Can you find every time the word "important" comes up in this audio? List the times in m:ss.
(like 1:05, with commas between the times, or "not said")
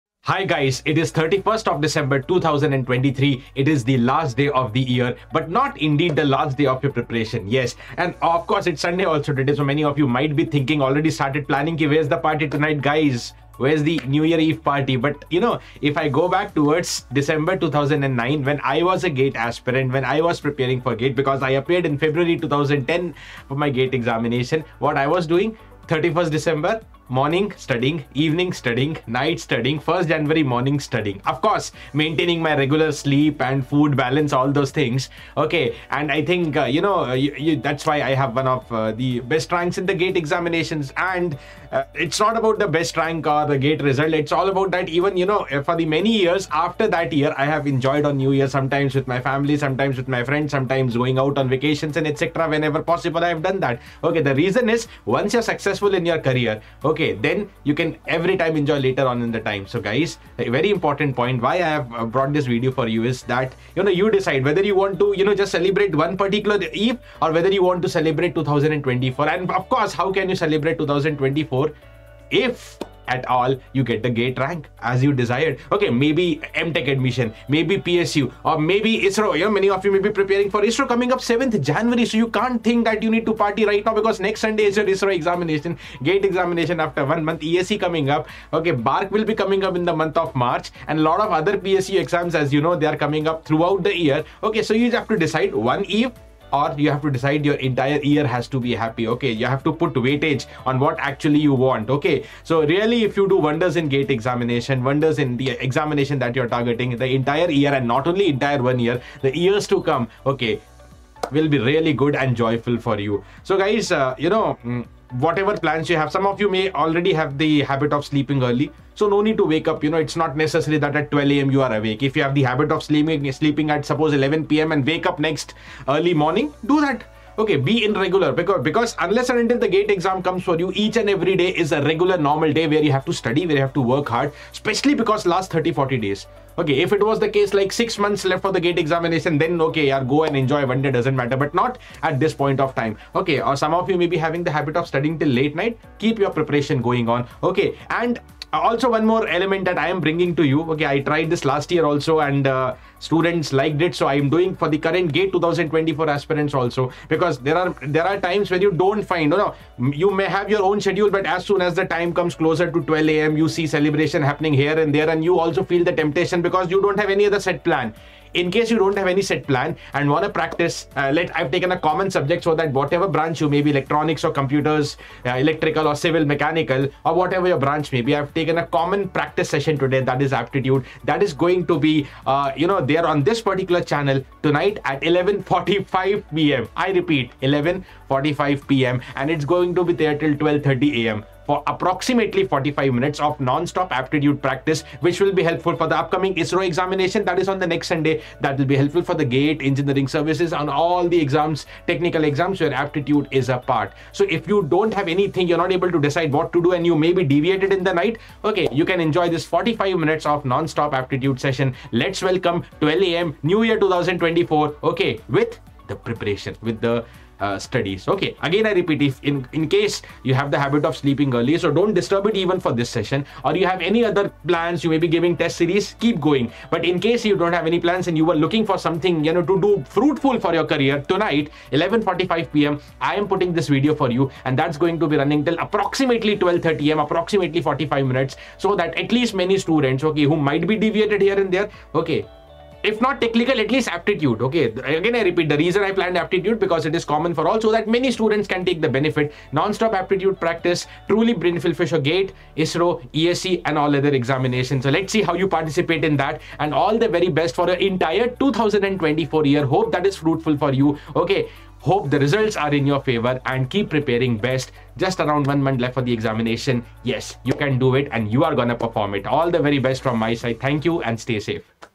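1:00.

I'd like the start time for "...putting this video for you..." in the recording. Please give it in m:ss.
3:53.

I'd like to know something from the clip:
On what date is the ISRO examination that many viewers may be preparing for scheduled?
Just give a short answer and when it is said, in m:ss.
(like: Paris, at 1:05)
7th January, at 1:21.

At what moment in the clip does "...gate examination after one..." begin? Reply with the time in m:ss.
1:26.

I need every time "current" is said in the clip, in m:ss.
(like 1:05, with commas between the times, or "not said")
2:34.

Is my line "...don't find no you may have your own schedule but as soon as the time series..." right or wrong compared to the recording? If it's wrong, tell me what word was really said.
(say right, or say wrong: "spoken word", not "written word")
wrong: "comes", not "series".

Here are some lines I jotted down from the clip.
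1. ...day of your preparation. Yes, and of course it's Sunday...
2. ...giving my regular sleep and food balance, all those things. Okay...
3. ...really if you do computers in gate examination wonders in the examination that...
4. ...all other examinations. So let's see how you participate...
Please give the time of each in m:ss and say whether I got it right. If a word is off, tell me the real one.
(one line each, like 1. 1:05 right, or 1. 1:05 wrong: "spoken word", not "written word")
1. 0:06 right
2. 0:31 wrong: "maintaining", not "giving"
3. 1:42 wrong: "wonders", not "computers"
4. 4:13 right.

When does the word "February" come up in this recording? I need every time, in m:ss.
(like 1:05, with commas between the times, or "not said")
0:21.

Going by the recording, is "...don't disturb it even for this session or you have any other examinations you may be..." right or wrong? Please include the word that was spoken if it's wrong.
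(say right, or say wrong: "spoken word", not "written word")
wrong: "plans", not "examinations".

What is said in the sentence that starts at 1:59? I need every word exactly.
You know, it's not necessary that at 12 a.m.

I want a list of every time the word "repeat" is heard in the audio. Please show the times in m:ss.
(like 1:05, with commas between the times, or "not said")
3:06, 3:38, 4:05.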